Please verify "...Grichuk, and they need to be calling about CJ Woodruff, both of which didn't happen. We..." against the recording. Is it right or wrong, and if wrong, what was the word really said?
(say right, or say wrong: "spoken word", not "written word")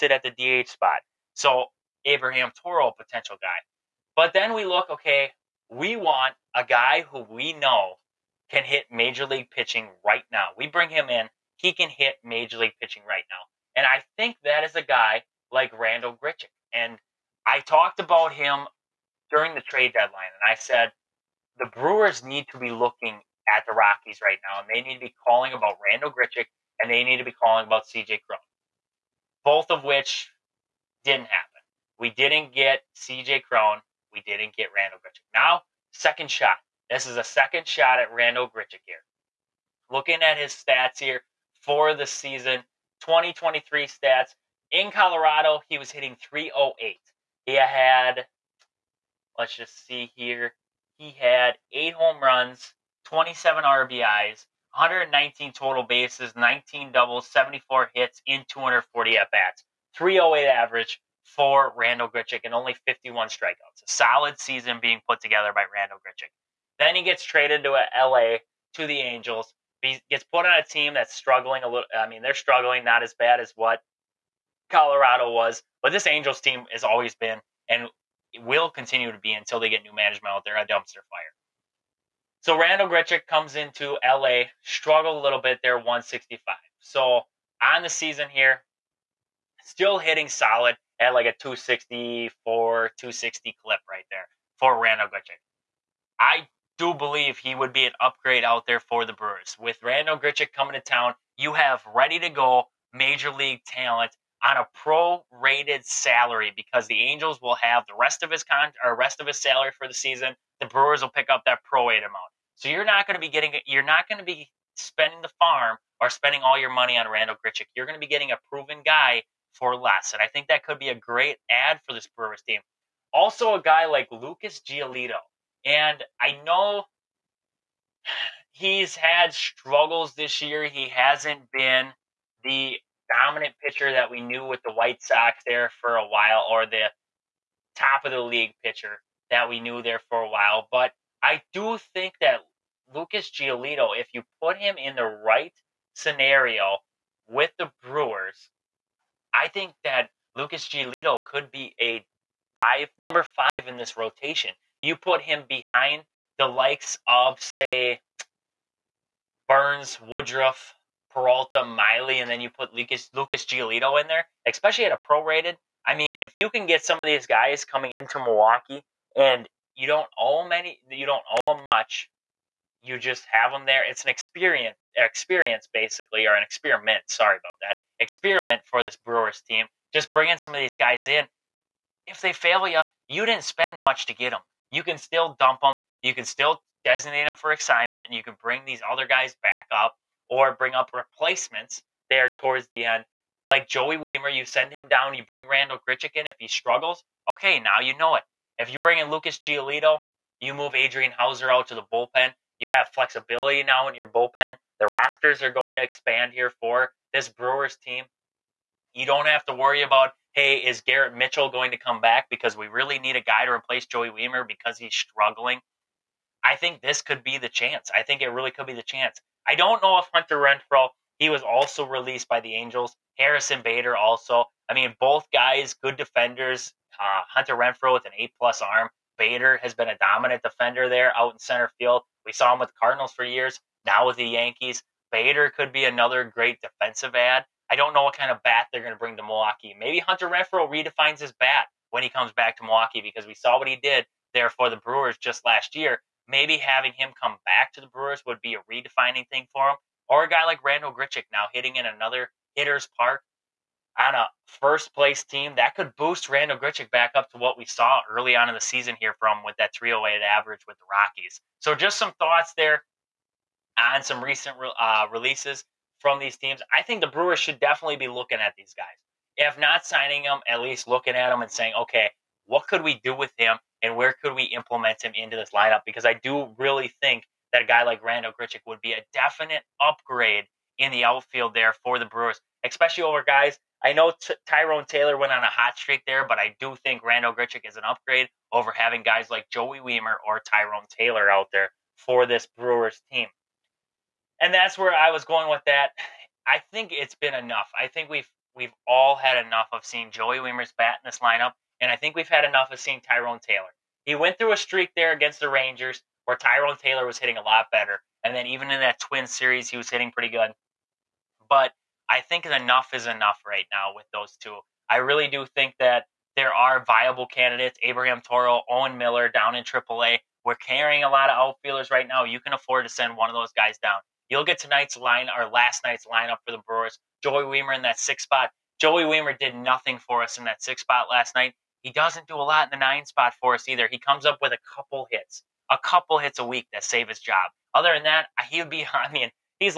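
wrong: "Cron", not "Woodruff".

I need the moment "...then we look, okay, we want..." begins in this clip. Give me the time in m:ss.
0:04.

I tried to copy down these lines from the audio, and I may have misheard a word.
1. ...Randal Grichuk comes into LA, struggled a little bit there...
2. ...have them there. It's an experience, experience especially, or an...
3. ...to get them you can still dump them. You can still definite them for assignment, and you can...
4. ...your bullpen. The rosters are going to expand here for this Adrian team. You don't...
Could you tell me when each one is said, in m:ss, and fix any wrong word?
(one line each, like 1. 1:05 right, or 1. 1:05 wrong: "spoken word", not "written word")
1. 1:22 right
2. 2:53 wrong: "basically", not "especially"
3. 3:04 wrong: "designate", not "definite"
4. 3:23 wrong: "Brewers", not "Adrian".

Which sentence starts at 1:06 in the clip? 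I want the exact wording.
Then he gets traded to uh, LA to the Angels.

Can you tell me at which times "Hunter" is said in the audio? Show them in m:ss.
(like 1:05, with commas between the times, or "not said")
3:40, 3:47, 3:59.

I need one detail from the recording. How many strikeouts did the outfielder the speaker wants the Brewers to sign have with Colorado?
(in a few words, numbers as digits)
51.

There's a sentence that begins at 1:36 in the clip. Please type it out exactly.
I do believe he would be an upgrade out there for the Brewers.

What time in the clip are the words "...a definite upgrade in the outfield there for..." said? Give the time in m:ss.
4:38.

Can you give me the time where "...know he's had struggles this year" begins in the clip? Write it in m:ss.
2:06.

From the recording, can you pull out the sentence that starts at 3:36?
I think this could be the chance.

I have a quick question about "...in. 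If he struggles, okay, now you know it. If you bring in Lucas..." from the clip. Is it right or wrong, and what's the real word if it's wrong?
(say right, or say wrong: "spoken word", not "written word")
right.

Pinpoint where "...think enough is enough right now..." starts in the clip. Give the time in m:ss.
5:12.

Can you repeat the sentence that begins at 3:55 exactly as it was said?
Bader could be another great defensive ad.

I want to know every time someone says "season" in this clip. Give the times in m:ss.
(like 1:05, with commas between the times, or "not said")
0:42, 1:04, 1:27, 1:49, 4:18.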